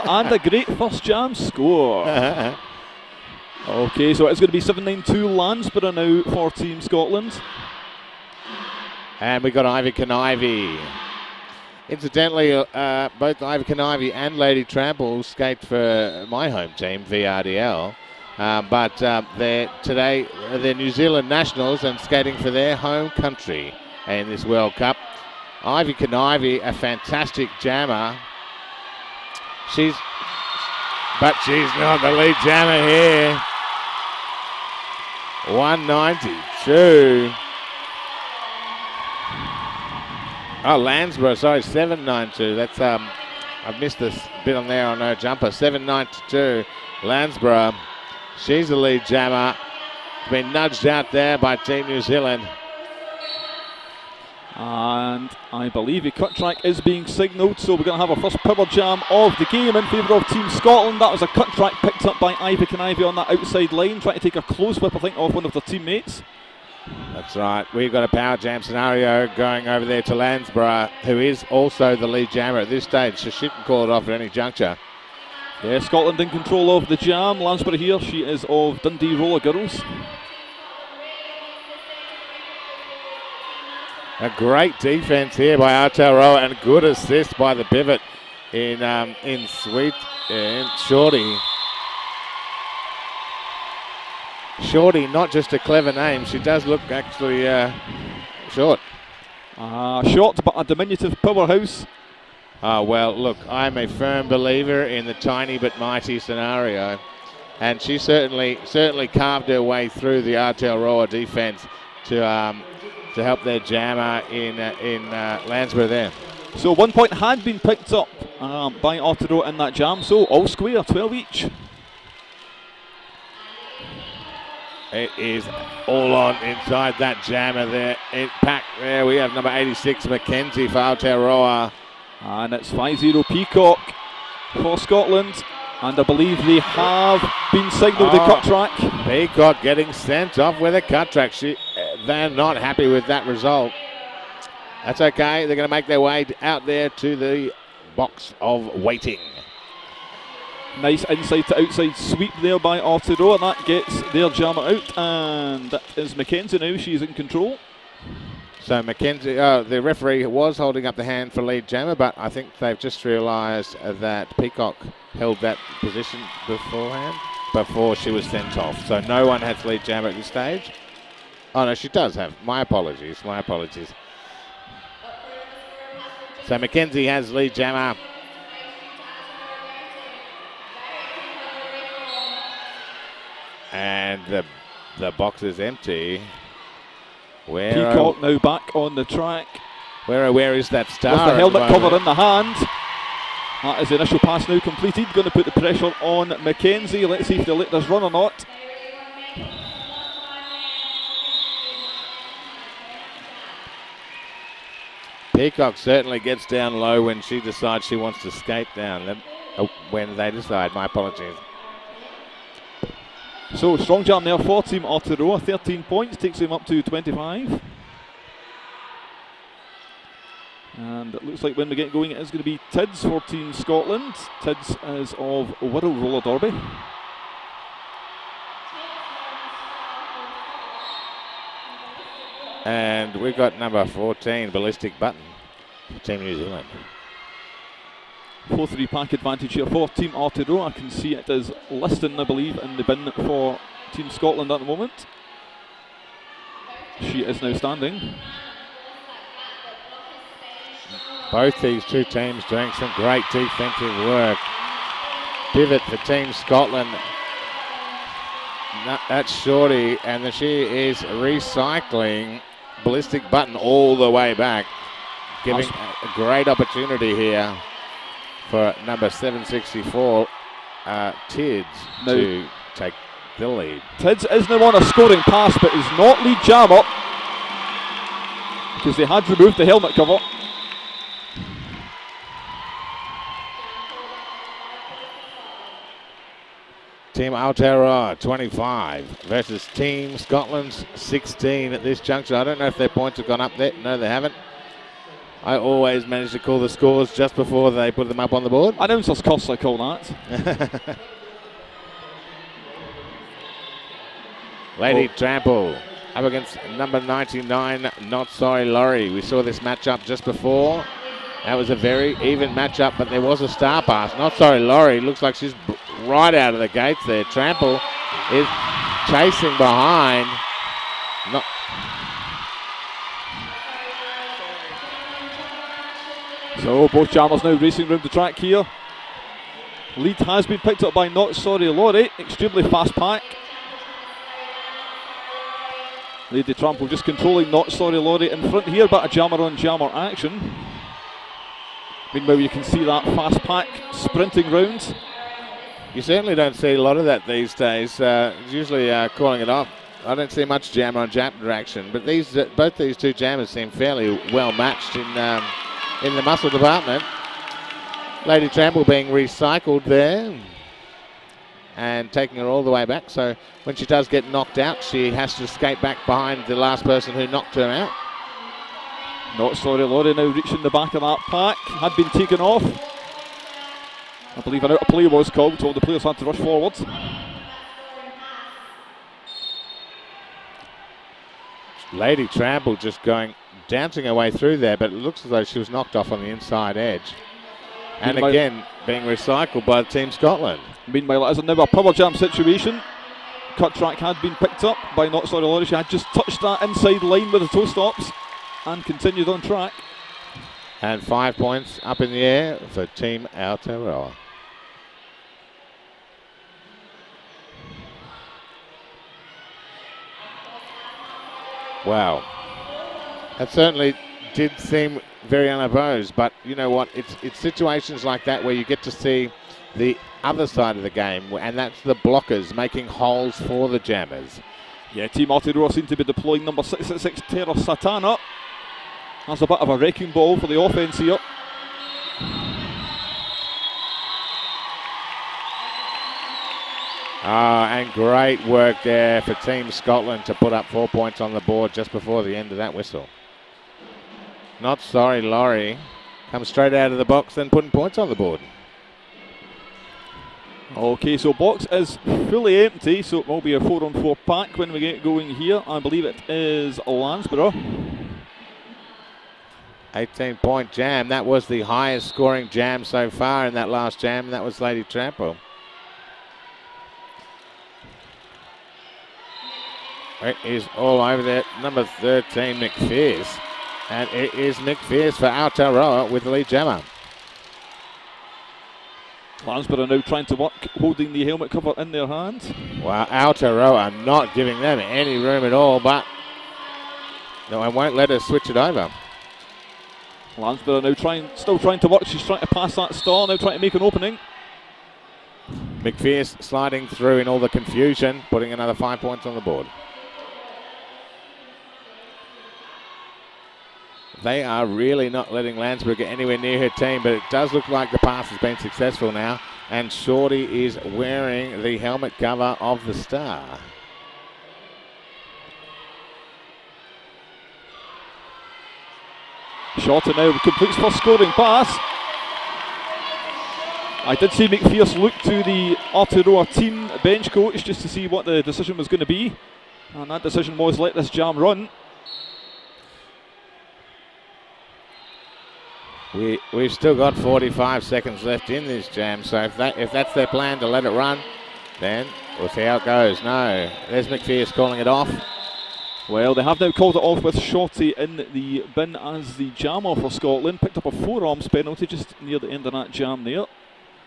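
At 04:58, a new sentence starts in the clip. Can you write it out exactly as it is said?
I don't just cost I call that.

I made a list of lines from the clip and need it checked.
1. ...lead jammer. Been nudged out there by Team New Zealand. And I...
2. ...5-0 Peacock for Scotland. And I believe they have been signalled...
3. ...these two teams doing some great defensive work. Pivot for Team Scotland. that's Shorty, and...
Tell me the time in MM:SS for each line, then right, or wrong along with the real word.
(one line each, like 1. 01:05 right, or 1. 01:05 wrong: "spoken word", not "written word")
1. 00:48 right
2. 02:12 right
3. 04:11 right.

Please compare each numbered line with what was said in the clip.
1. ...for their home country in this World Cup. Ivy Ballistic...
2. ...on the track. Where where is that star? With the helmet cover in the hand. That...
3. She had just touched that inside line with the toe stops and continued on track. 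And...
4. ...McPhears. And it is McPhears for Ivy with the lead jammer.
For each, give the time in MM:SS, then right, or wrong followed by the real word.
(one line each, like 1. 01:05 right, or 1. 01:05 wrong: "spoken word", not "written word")
1. 00:22 wrong: "Canivy", not "Ballistic"
2. 03:08 right
3. 06:35 right
4. 07:52 wrong: "Aotearoa", not "Ivy".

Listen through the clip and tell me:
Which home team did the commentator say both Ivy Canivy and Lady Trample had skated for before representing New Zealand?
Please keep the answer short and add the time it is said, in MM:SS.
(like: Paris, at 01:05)
VRDL, at 00:17.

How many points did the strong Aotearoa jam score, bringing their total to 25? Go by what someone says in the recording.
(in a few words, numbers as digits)
13.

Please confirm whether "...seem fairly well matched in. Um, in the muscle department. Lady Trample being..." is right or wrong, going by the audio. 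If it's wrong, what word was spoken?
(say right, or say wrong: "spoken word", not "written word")
right.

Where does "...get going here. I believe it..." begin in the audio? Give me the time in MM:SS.
07:34.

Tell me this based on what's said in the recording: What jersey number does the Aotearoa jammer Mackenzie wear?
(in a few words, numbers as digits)
86.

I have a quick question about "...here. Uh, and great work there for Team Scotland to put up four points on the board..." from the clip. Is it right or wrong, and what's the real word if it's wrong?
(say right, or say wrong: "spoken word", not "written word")
right.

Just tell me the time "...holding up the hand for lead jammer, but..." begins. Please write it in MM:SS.
02:40.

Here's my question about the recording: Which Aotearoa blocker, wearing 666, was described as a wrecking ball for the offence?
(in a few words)
Tera Satana.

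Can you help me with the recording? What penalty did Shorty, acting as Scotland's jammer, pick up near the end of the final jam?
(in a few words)
Forearms.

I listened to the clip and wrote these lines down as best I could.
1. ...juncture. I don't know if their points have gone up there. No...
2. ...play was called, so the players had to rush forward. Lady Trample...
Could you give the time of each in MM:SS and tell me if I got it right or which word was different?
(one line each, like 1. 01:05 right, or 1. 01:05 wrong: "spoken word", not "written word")
1. 04:51 right
2. 06:14 right.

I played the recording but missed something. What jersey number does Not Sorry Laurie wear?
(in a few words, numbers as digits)
99.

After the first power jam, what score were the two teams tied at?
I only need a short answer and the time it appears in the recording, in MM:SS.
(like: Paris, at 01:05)
12, at 02:00.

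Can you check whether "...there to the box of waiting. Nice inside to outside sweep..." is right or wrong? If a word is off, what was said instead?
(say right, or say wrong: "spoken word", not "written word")
right.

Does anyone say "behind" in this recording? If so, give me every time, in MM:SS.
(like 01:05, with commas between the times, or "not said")
05:19, 06:06.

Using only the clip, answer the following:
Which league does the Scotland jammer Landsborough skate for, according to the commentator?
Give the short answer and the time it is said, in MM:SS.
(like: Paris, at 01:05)
Dundee Roller Girls, at 01:18.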